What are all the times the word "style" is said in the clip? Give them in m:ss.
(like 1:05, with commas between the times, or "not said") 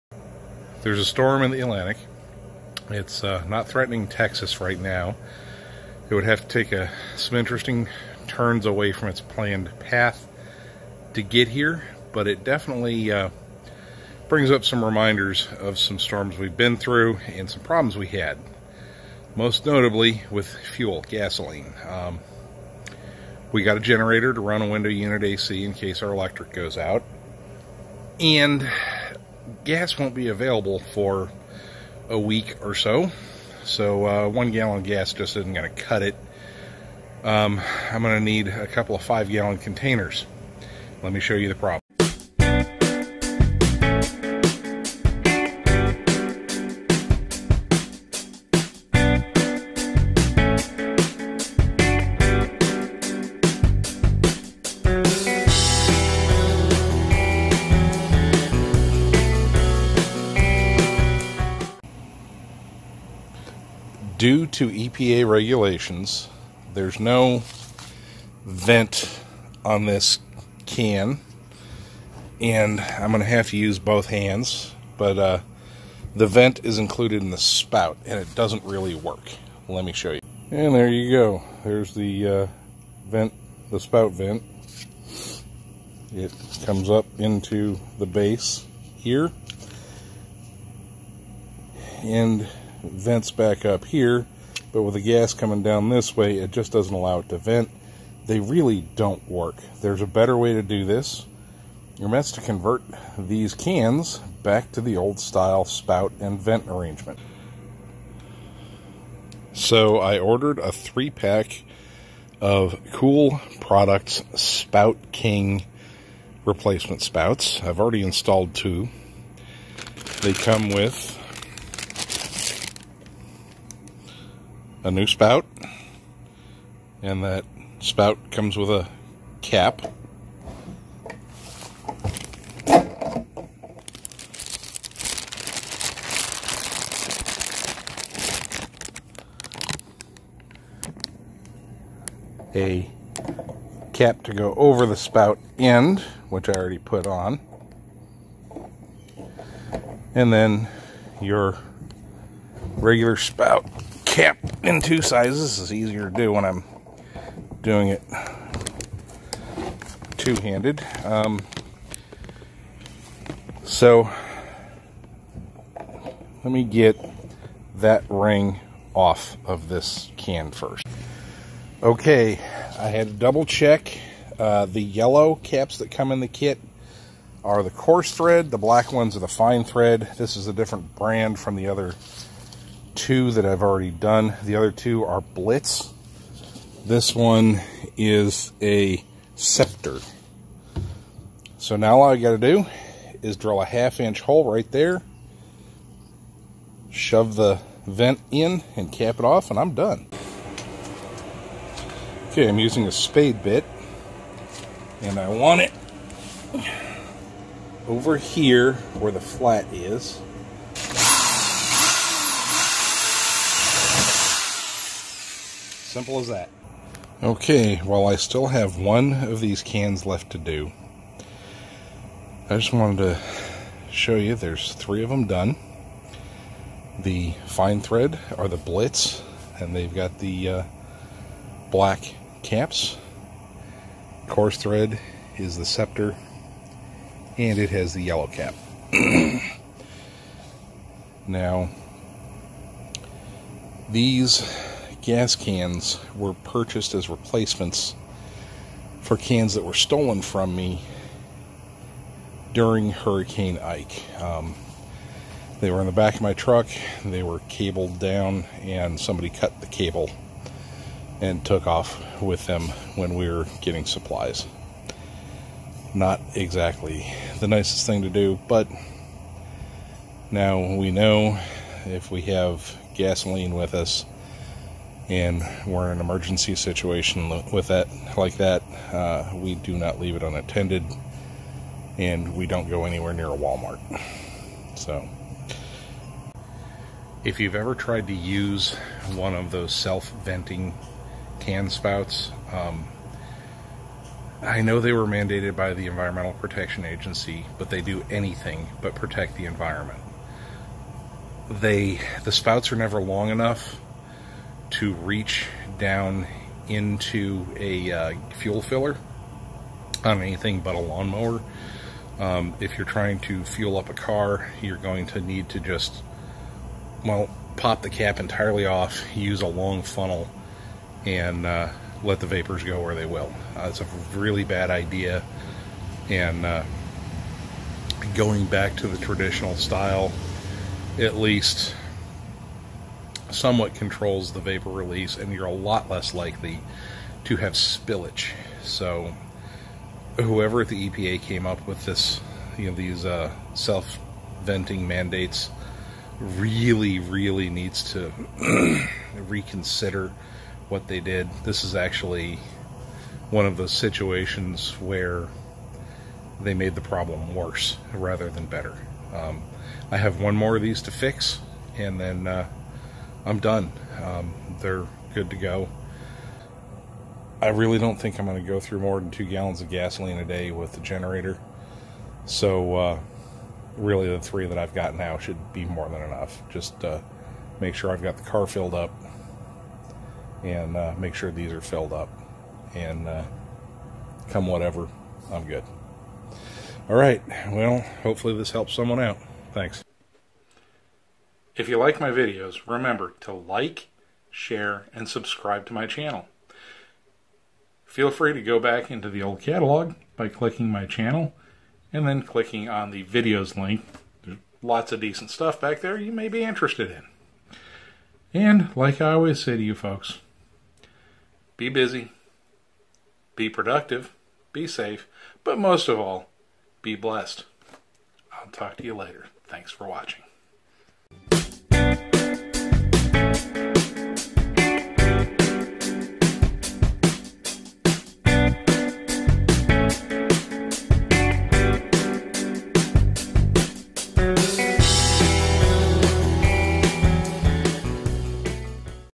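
1:45, 5:29.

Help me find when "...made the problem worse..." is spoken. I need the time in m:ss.
5:56.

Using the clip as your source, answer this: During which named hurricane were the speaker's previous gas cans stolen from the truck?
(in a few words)
Hurricane Ike.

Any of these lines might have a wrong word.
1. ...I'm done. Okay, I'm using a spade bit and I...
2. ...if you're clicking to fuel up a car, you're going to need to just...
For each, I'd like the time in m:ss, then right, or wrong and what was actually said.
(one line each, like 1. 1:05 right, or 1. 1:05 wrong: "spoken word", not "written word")
1. 3:19 right
2. 5:12 wrong: "trying", not "clicking".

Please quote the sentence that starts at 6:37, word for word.
Feel free to go back into the old catalog by clicking my channel and then clicking on the videos link.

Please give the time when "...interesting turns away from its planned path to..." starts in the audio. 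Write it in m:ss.
0:07.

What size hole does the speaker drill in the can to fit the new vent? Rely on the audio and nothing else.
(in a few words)
half inch.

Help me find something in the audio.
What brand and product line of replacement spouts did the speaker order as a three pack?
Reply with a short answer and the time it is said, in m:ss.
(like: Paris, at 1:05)
Kool Products Spout King, at 1:52.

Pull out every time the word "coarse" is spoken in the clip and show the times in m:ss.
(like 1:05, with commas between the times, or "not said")
2:57, 3:54.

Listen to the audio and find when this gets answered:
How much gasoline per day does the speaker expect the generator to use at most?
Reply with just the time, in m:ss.
6:09.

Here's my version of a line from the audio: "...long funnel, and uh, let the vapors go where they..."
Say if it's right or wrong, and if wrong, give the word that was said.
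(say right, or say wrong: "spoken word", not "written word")
right.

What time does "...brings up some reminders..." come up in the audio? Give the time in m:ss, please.
0:14.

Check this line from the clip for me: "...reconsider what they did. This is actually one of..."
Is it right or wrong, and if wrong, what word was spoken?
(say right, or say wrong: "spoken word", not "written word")
right.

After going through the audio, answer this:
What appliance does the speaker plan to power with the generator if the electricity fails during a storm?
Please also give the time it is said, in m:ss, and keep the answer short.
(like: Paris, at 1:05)
window unit AC, at 0:24.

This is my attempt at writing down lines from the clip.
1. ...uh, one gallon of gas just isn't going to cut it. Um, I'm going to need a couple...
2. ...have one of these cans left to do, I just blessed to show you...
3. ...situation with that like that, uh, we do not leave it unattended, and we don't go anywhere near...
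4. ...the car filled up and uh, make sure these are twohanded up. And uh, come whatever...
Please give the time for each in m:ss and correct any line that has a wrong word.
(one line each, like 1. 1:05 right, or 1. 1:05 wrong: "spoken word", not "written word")
1. 0:34 right
2. 3:38 wrong: "wanted", not "blessed"
3. 4:36 right
4. 6:18 wrong: "filled", not "twohanded".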